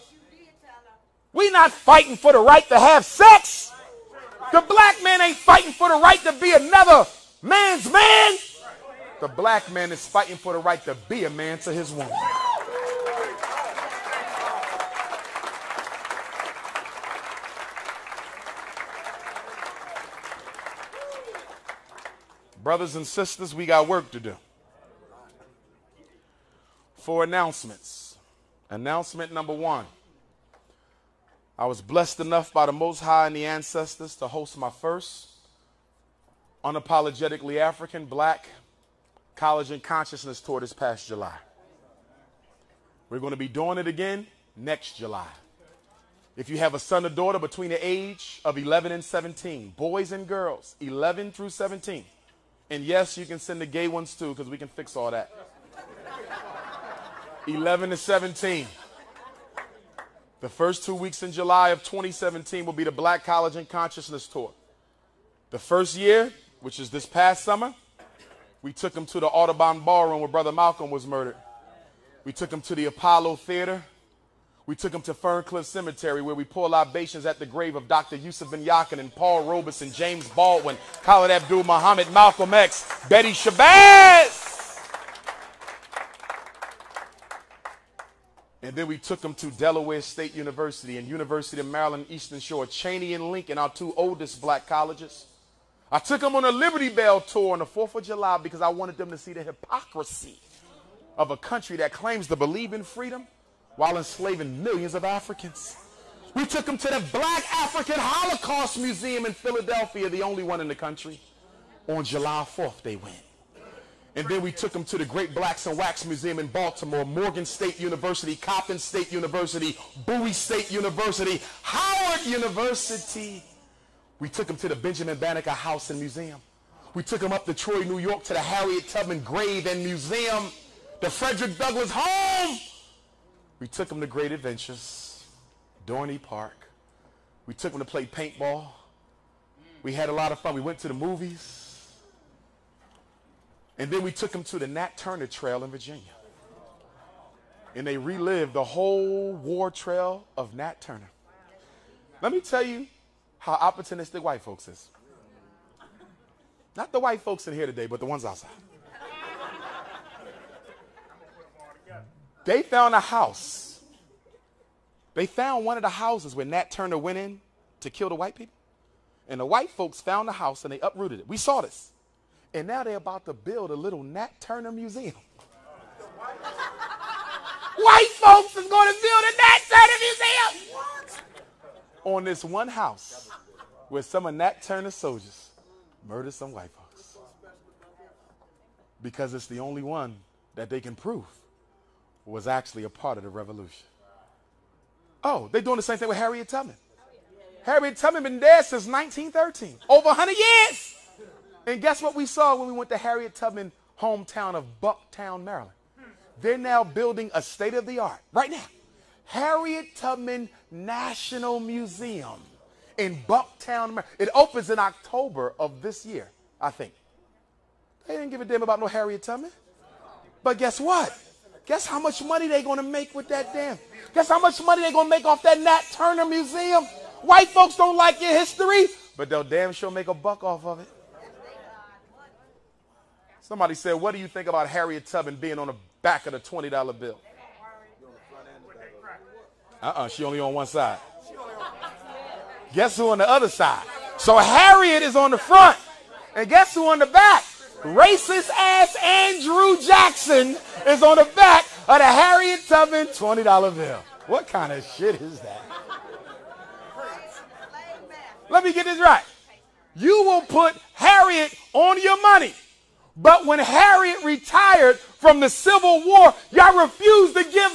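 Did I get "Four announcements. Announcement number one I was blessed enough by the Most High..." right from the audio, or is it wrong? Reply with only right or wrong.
right.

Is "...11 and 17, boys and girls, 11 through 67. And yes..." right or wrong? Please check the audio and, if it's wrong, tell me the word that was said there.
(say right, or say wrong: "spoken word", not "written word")
wrong: "17", not "67".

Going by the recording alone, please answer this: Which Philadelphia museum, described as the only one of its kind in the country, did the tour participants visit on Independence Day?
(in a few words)
Black African Holocaust Museum.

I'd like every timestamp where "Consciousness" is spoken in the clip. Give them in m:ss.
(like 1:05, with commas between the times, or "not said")
0:39, 1:03.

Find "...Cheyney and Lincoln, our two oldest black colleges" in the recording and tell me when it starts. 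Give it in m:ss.
1:32.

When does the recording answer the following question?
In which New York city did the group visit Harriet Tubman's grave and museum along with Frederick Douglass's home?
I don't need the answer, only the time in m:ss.
2:07.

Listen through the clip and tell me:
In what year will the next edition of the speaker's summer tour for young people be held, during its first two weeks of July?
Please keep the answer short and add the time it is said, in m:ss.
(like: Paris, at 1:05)
2017, at 1:01.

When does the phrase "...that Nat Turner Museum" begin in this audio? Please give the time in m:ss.
3:45.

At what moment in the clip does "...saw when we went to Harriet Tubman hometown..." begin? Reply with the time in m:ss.
3:22.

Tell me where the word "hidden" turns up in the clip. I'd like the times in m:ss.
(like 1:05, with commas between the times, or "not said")
not said.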